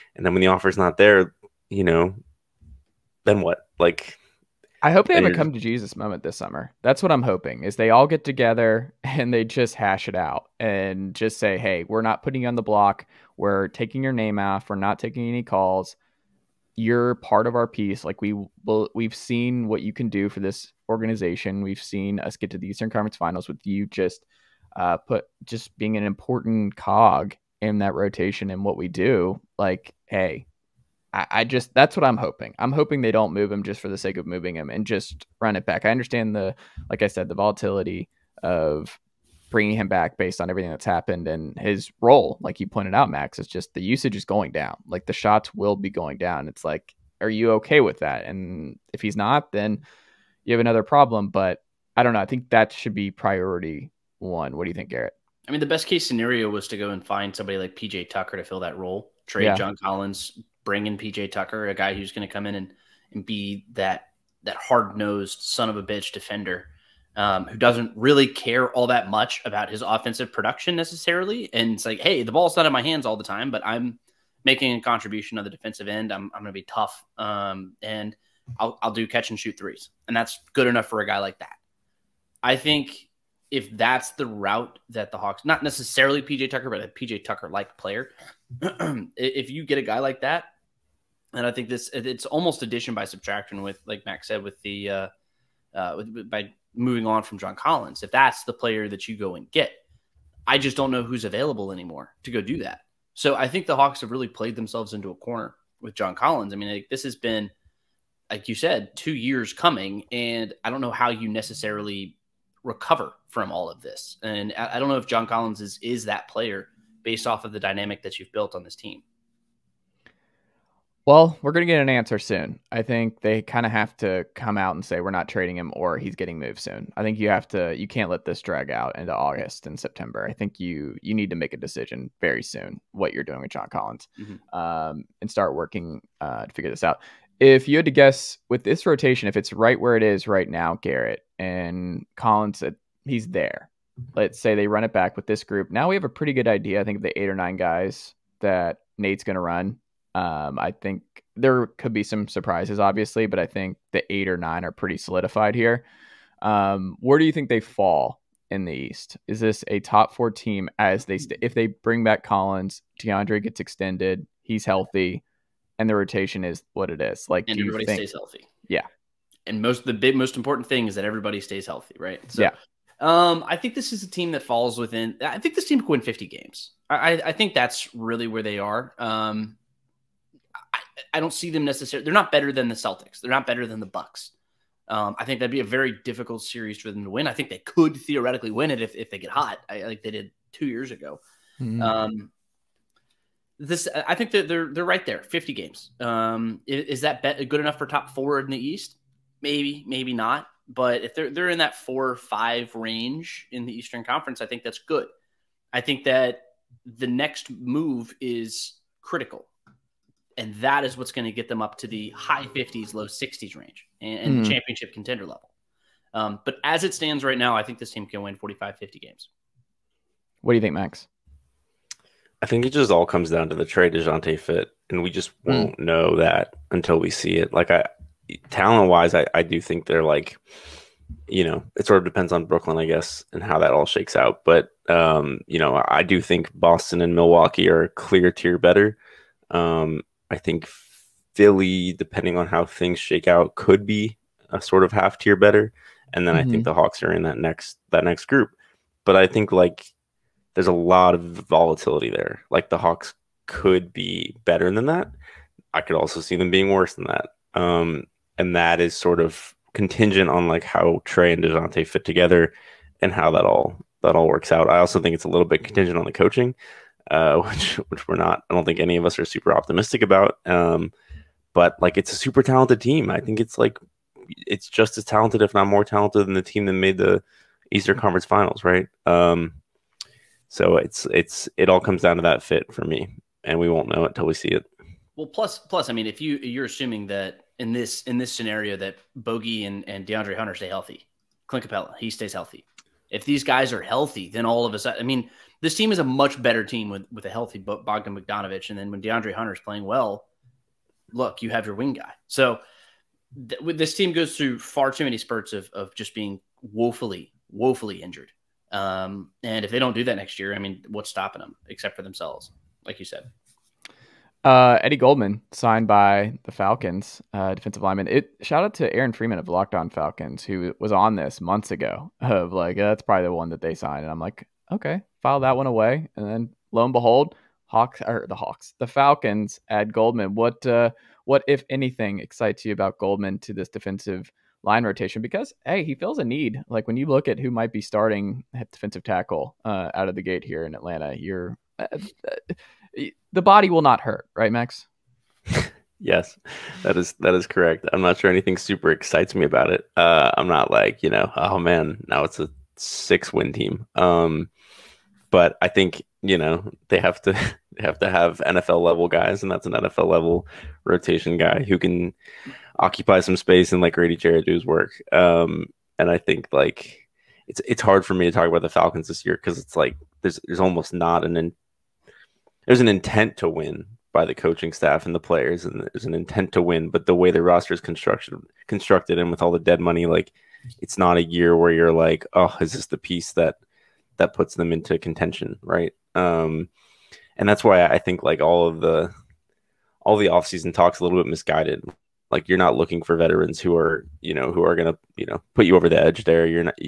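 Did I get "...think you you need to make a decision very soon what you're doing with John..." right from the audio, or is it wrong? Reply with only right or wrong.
right.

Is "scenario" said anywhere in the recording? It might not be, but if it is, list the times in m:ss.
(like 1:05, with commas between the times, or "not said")
0:56, 4:48.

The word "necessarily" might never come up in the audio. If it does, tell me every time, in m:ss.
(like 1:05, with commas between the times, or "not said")
1:10, 1:25, 1:51, 3:01.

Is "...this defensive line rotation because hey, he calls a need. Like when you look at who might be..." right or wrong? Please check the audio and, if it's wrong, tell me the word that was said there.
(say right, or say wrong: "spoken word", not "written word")
wrong: "feels", not "calls".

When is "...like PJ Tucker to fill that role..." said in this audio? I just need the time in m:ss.
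0:57.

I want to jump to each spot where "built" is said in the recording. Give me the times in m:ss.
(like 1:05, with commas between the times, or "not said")
1:58.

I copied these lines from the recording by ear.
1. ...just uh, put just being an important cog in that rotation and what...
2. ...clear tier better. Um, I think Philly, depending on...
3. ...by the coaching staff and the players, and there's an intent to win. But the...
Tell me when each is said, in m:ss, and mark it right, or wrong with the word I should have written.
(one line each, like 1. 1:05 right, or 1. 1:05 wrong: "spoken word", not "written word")
1. 0:23 right
2. 3:57 right
3. 6:14 right.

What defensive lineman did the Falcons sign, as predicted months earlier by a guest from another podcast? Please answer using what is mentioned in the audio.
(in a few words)
Eddie Goldman.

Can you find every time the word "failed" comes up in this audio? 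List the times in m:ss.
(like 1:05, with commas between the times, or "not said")
not said.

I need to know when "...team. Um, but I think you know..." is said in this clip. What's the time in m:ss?
5:53.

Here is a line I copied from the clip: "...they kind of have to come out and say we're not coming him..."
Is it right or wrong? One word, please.
wrong.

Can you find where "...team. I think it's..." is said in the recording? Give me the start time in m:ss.
4:32.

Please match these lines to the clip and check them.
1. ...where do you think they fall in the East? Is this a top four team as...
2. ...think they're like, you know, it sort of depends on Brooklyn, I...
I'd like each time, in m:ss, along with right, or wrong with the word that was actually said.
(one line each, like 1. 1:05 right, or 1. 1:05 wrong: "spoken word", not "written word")
1. 2:37 right
2. 3:49 right.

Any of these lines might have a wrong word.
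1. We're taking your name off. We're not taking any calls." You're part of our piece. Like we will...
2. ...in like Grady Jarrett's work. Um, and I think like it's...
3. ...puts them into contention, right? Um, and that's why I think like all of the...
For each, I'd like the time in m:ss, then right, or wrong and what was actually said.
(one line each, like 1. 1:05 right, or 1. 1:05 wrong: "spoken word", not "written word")
1. 0:13 right
2. 6:03 right
3. 6:24 right.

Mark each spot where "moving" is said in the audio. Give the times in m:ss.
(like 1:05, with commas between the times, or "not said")
0:34, 1:36.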